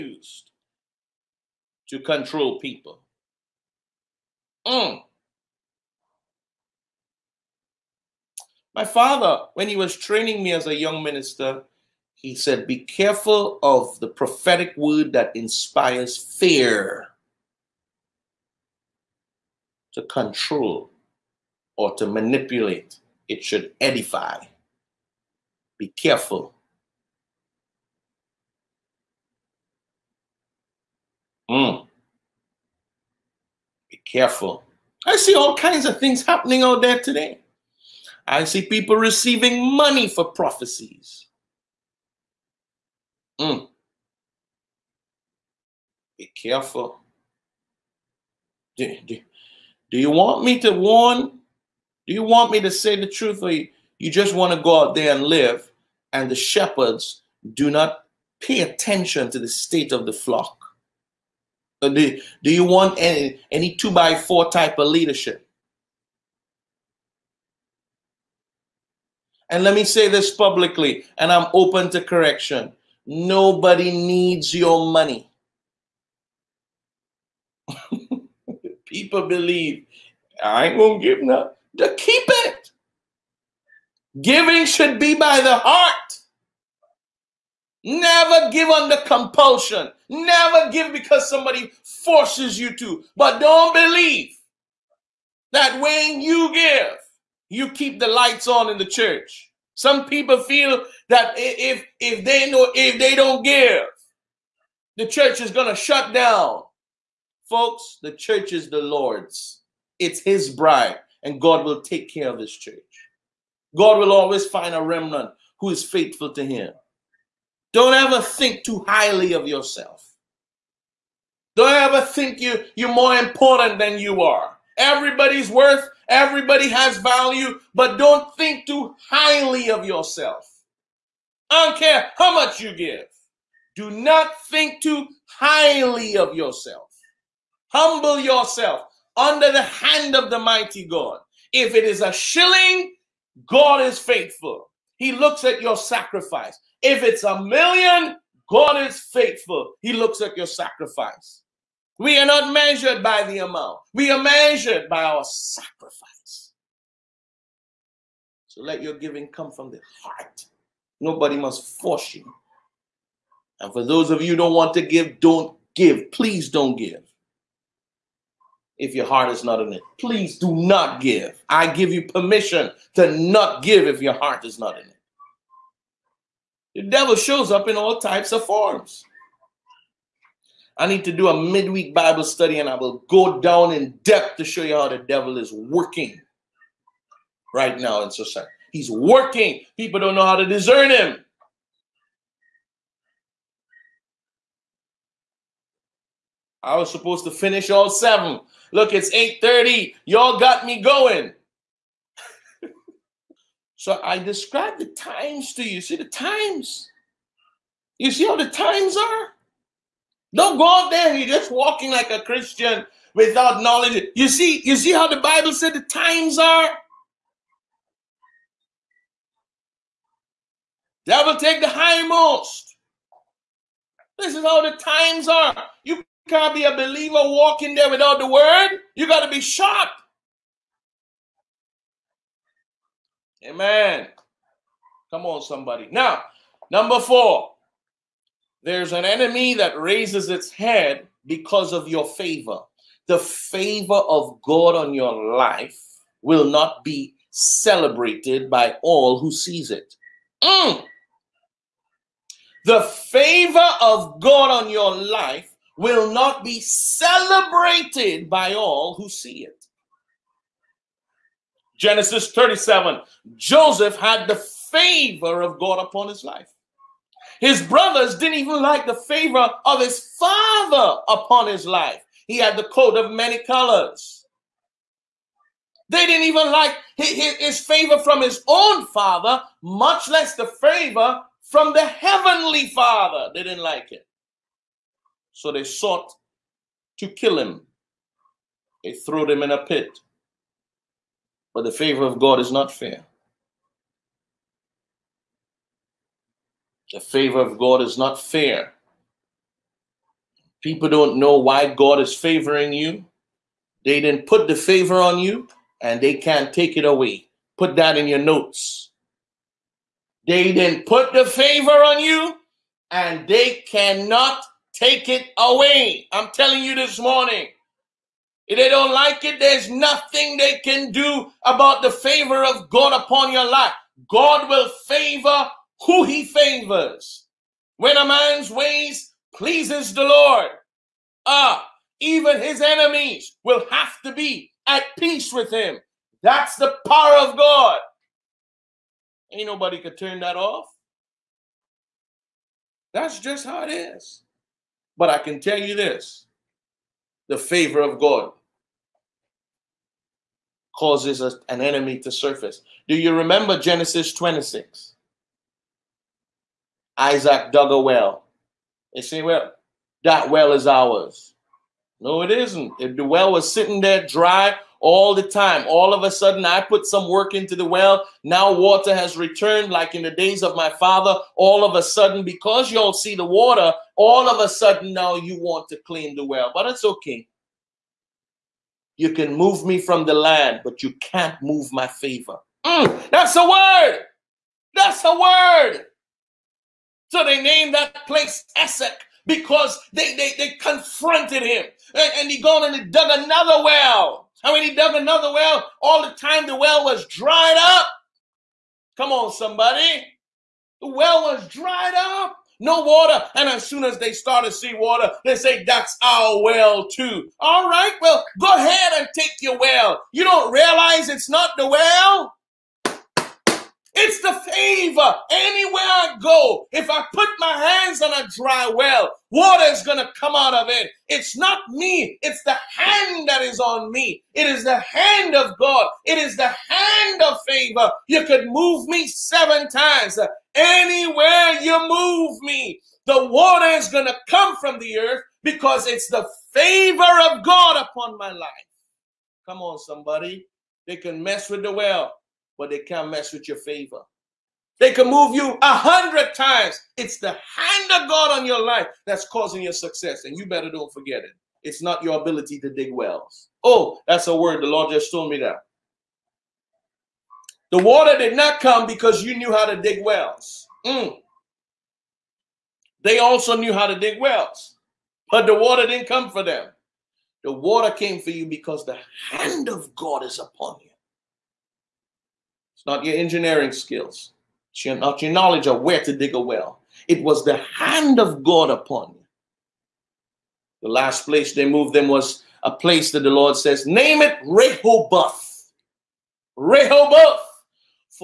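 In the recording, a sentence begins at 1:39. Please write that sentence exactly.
Some people feel that if if they know if they don't give, the church is gonna shut down.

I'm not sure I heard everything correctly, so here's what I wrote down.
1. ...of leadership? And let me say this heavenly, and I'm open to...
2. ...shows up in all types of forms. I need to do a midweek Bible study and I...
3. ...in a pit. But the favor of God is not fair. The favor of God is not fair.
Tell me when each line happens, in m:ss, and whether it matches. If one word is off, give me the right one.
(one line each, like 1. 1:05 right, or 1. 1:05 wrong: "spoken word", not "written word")
1. 1:04 wrong: "publicly", not "heavenly"
2. 2:57 right
3. 4:49 right.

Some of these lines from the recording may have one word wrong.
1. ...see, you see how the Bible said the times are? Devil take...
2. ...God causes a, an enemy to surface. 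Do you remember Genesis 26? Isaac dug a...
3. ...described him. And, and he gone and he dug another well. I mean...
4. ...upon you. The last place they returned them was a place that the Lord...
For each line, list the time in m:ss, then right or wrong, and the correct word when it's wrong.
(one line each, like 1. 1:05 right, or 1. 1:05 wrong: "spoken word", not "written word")
1. 3:34 right
2. 5:47 right
3. 6:30 wrong: "confronted", not "described"
4. 7:58 wrong: "moved", not "returned".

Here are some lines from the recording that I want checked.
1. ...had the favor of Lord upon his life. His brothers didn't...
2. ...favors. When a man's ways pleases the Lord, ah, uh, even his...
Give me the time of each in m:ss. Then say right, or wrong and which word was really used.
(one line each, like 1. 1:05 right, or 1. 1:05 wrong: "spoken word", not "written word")
1. 4:23 wrong: "God", not "Lord"
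2. 5:26 right.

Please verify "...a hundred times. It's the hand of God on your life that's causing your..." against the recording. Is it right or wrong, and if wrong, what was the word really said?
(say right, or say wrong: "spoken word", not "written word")
right.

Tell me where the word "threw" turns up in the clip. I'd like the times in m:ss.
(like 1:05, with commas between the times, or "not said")
4:48.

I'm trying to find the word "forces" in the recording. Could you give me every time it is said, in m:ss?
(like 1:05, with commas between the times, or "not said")
1:31, 2:41.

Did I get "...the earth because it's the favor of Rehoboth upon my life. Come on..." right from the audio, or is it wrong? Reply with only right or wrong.
wrong.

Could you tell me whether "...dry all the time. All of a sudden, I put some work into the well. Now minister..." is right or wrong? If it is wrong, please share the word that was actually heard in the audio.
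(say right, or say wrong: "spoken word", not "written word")
wrong: "water", not "minister".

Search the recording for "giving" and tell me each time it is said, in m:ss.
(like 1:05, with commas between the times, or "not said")
1:24, 2:38.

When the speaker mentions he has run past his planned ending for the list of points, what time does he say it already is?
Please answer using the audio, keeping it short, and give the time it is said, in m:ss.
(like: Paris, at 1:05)
8:30, at 3:19.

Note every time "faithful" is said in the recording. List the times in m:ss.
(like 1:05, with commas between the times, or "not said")
1:55, 2:23, 2:29.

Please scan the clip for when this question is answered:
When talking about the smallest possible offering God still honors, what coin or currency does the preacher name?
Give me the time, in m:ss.
2:22.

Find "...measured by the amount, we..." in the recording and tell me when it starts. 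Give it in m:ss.
2:32.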